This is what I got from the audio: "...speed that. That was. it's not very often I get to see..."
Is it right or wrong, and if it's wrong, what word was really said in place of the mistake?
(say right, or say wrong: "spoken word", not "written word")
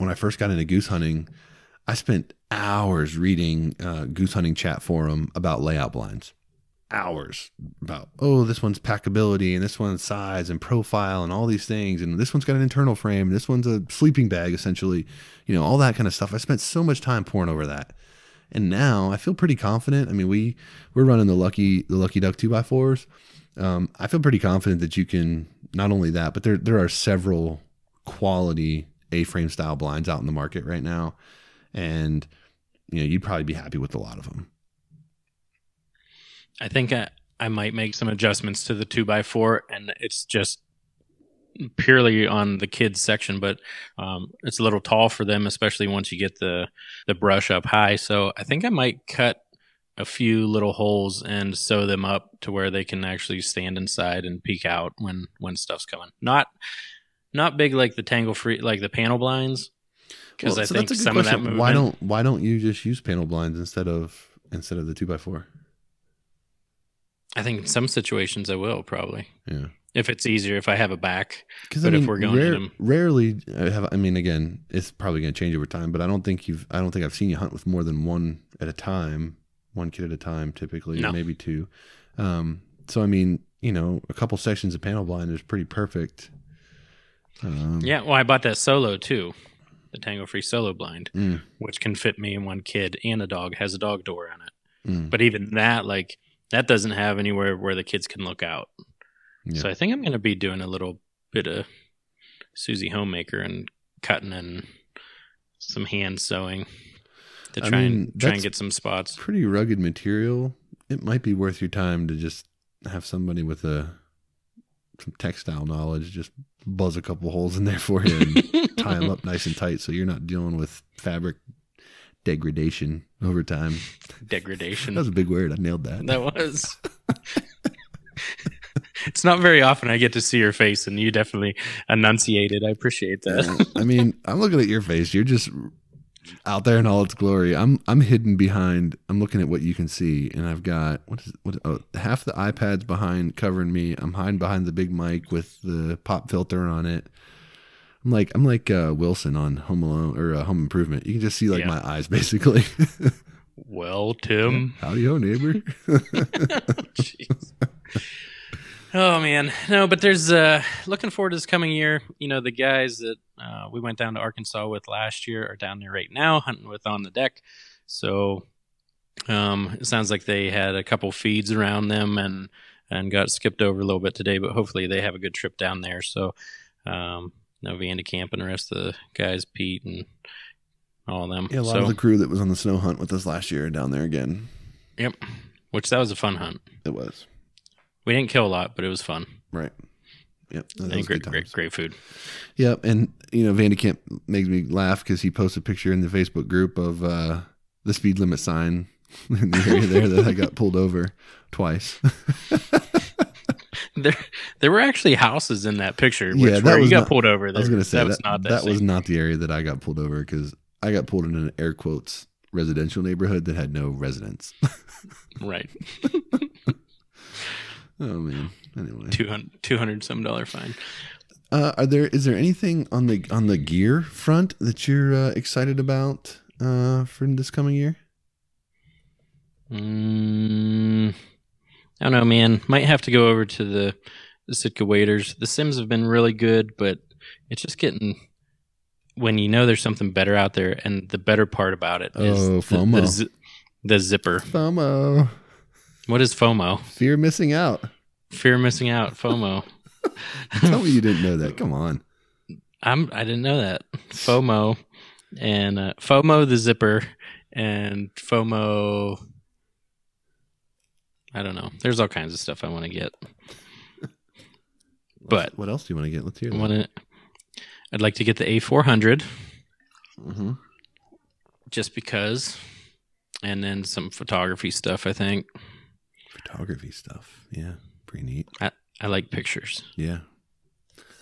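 wrong: "nailed", not "speed".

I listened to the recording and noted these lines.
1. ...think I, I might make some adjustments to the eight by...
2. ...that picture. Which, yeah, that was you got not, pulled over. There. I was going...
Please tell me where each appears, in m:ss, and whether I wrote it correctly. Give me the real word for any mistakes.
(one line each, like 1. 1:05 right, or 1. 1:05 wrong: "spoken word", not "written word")
1. 0:36 wrong: "two", not "eight"
2. 3:25 right.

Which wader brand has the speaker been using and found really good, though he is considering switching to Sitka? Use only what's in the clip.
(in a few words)
Simms.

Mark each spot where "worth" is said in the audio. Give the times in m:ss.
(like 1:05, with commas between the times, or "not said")
1:51.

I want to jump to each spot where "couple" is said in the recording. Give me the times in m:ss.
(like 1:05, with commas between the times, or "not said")
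1:24, 1:57, 2:50.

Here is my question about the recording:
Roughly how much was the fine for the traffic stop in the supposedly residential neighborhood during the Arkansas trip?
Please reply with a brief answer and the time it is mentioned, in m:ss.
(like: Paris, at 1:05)
200 some dollars, at 3:39.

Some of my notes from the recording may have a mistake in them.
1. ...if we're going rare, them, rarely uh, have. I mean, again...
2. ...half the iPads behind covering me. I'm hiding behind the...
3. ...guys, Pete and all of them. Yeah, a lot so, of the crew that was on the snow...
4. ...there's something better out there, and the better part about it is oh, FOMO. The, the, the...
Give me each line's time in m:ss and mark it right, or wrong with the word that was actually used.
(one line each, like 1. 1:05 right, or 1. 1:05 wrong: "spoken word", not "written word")
1. 1:12 right
2. 2:21 right
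3. 2:59 right
4. 3:59 right.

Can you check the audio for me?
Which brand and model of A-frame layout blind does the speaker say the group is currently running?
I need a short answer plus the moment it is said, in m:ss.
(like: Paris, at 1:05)
Lucky Duck 2x4, at 0:21.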